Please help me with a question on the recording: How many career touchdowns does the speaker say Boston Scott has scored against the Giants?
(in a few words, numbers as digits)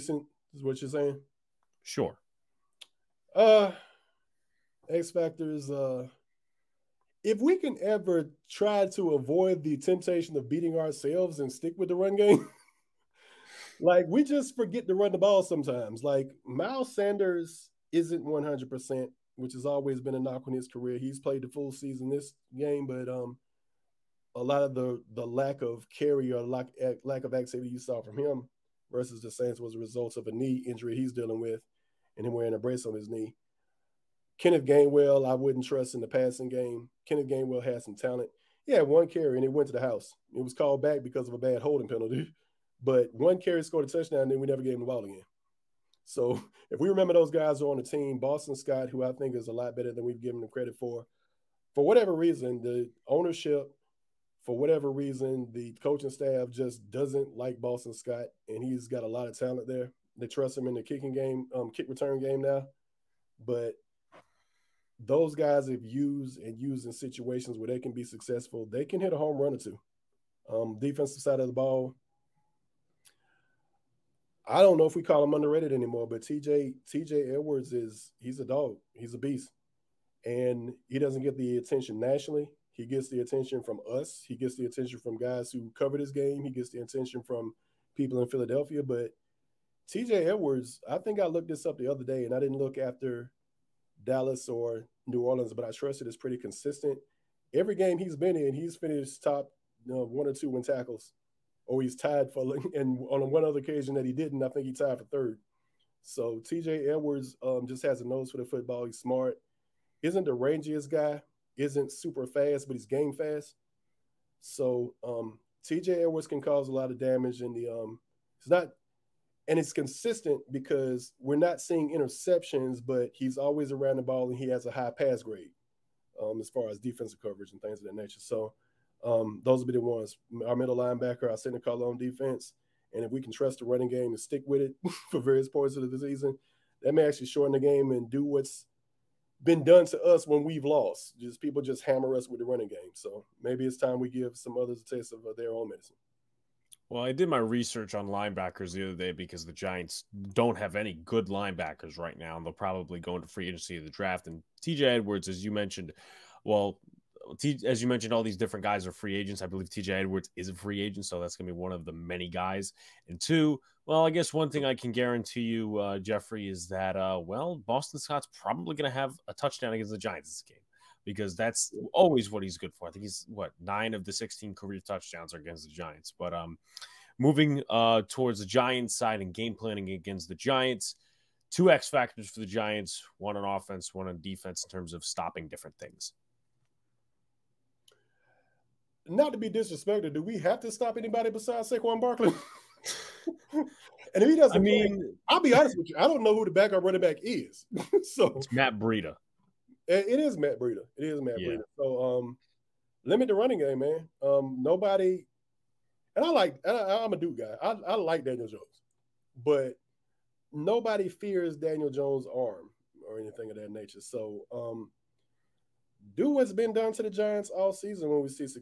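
9.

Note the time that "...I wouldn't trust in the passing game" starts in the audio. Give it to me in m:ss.
0:35.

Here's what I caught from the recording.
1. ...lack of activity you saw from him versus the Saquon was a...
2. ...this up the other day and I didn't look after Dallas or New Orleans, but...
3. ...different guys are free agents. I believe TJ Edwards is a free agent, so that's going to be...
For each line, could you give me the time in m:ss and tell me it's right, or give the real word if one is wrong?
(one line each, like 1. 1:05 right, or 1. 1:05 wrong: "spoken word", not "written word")
1. 0:27 wrong: "Saints", not "Saquon"
2. 1:31 right
3. 2:38 right.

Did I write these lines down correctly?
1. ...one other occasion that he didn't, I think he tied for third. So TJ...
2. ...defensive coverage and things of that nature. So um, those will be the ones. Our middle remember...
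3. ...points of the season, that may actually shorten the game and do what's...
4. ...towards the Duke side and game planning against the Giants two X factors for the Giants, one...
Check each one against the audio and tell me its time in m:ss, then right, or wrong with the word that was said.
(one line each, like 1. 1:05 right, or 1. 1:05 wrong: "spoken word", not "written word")
1. 1:43 right
2. 2:06 wrong: "linebacker", not "remember"
3. 2:15 right
4. 2:58 wrong: "Giants", not "Duke".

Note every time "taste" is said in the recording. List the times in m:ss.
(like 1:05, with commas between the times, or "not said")
2:24.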